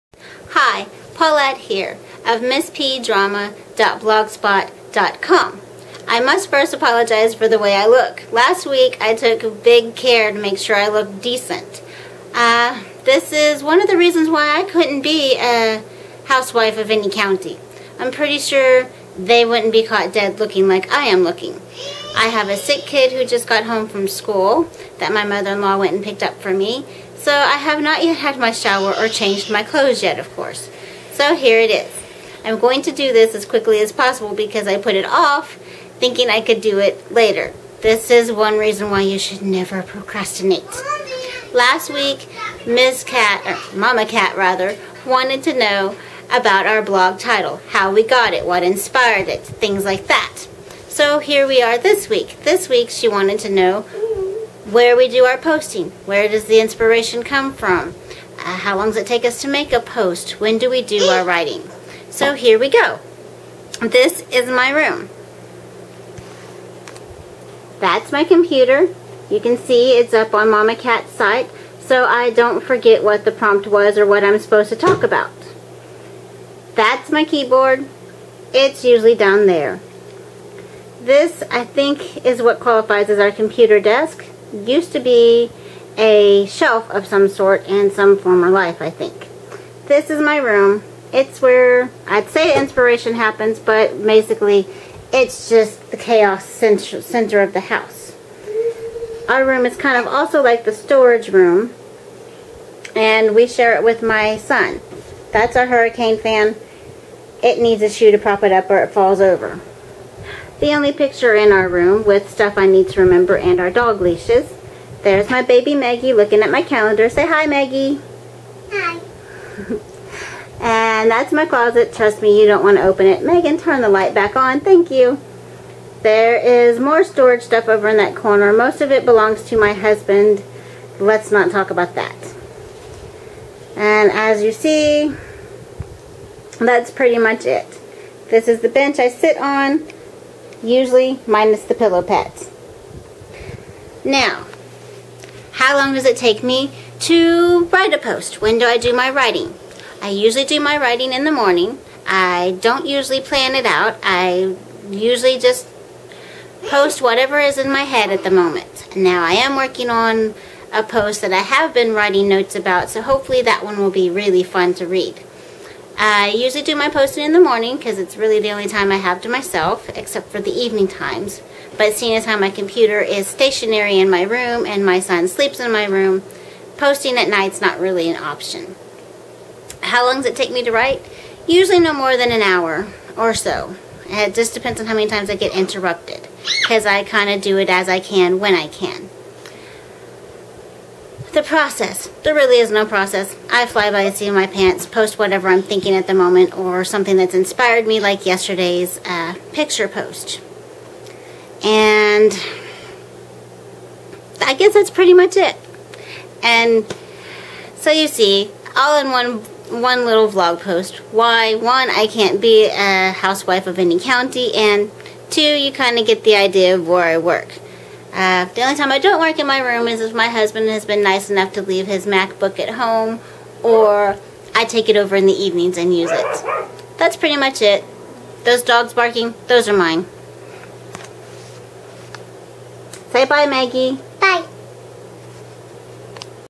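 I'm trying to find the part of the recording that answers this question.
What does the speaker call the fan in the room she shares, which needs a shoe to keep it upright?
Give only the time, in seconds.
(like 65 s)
105 s.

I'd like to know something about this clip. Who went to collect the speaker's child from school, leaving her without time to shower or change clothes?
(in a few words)
Mother-in-law.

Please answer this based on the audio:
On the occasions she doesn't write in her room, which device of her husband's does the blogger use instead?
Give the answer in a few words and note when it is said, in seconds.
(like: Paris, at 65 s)
MacBook, at 222 s.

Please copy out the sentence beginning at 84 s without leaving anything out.
Used to be a shelf of some sort in some former life, I think.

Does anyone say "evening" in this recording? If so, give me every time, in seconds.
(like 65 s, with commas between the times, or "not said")
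170 s, 225 s.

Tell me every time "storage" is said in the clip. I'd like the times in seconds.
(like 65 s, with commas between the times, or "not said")
100 s, 127 s.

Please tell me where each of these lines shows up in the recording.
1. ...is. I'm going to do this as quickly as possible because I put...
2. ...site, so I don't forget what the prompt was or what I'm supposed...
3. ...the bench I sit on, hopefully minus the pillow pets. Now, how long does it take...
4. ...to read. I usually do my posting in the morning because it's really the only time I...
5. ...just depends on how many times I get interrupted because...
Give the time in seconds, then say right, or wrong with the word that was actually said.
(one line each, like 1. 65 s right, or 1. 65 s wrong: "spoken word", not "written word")
1. 31 s right
2. 71 s right
3. 138 s wrong: "usually", not "hopefully"
4. 164 s right
5. 184 s right.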